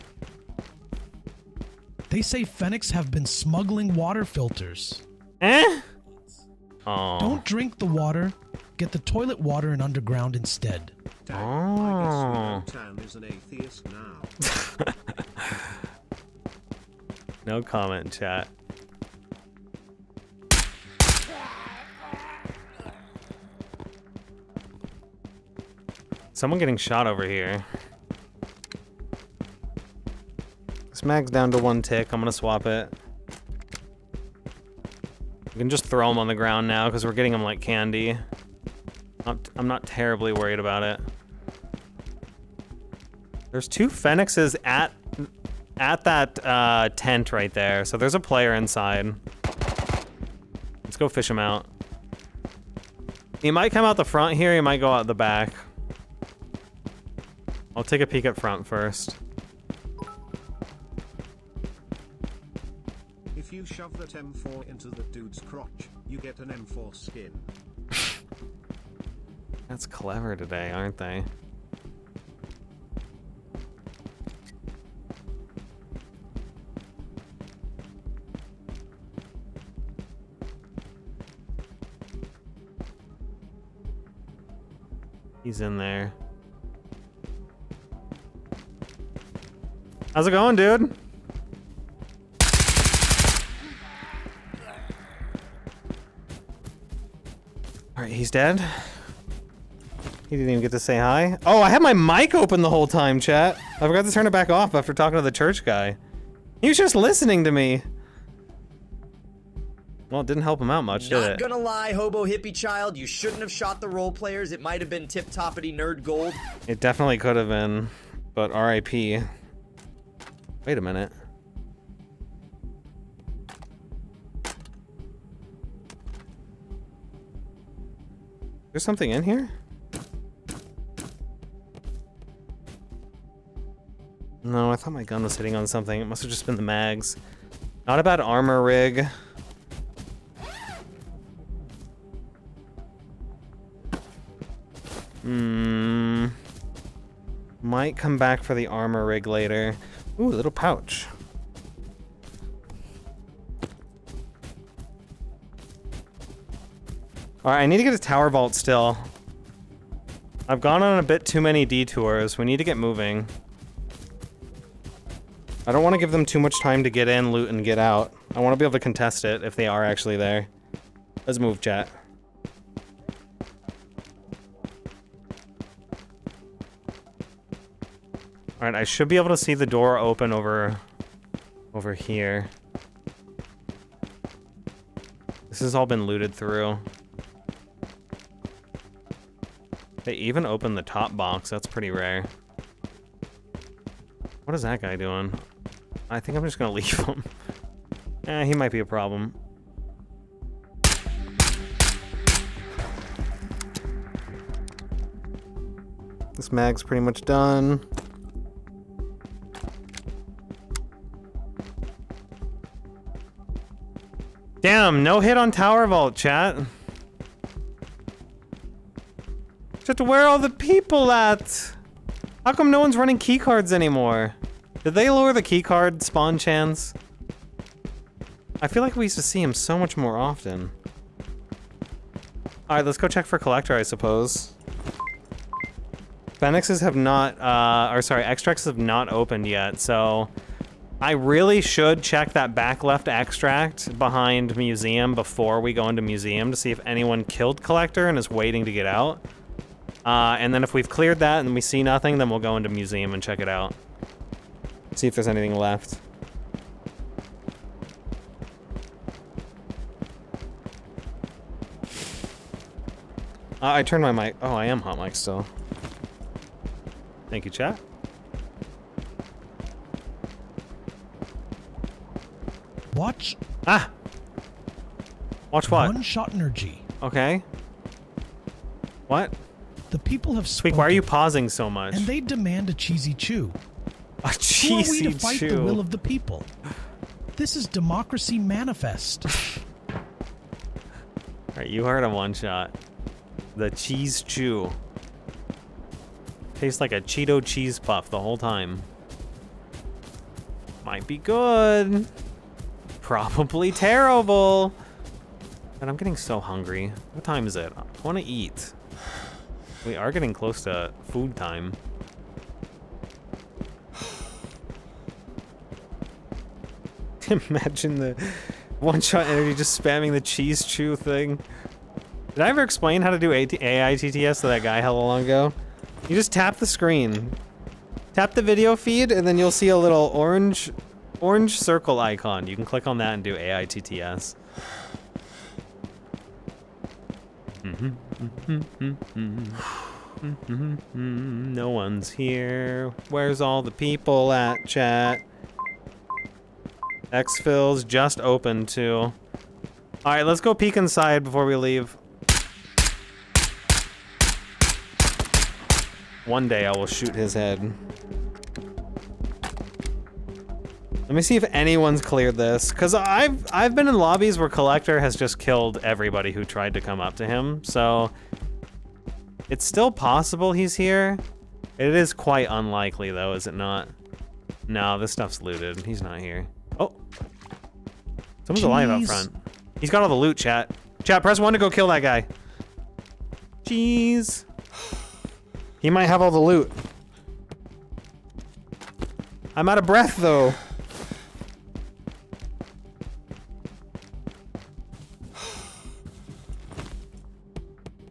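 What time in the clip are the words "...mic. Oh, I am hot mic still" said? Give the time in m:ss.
4:24.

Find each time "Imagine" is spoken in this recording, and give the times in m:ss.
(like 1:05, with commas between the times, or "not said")
5:17.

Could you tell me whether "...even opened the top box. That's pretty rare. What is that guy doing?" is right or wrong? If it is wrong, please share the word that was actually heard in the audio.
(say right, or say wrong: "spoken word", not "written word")
right.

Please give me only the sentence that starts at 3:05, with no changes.
This has all been looted through.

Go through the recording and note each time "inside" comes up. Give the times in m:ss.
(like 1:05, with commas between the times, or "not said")
0:48, 5:50.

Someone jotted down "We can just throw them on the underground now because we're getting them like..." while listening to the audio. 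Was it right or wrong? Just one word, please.
wrong.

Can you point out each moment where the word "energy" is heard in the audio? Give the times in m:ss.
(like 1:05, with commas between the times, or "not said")
4:36, 5:19.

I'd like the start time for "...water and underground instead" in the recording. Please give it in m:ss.
0:09.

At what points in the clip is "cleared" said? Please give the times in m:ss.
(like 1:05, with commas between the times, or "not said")
4:10, 6:02.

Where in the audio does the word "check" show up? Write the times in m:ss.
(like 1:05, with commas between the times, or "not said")
3:53, 4:02, 4:13.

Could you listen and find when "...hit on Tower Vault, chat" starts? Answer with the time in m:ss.
3:35.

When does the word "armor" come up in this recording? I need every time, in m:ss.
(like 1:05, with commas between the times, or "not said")
2:18, 2:28.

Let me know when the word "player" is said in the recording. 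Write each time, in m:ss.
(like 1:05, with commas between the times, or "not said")
0:48, 1:54.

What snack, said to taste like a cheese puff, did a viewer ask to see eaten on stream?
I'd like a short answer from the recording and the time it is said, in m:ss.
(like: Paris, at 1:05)
cheesy chew, at 4:42.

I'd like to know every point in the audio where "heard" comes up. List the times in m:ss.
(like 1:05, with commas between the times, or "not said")
4:51.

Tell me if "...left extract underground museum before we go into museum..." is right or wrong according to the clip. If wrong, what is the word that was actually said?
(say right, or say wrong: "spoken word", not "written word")
wrong: "behind", not "underground".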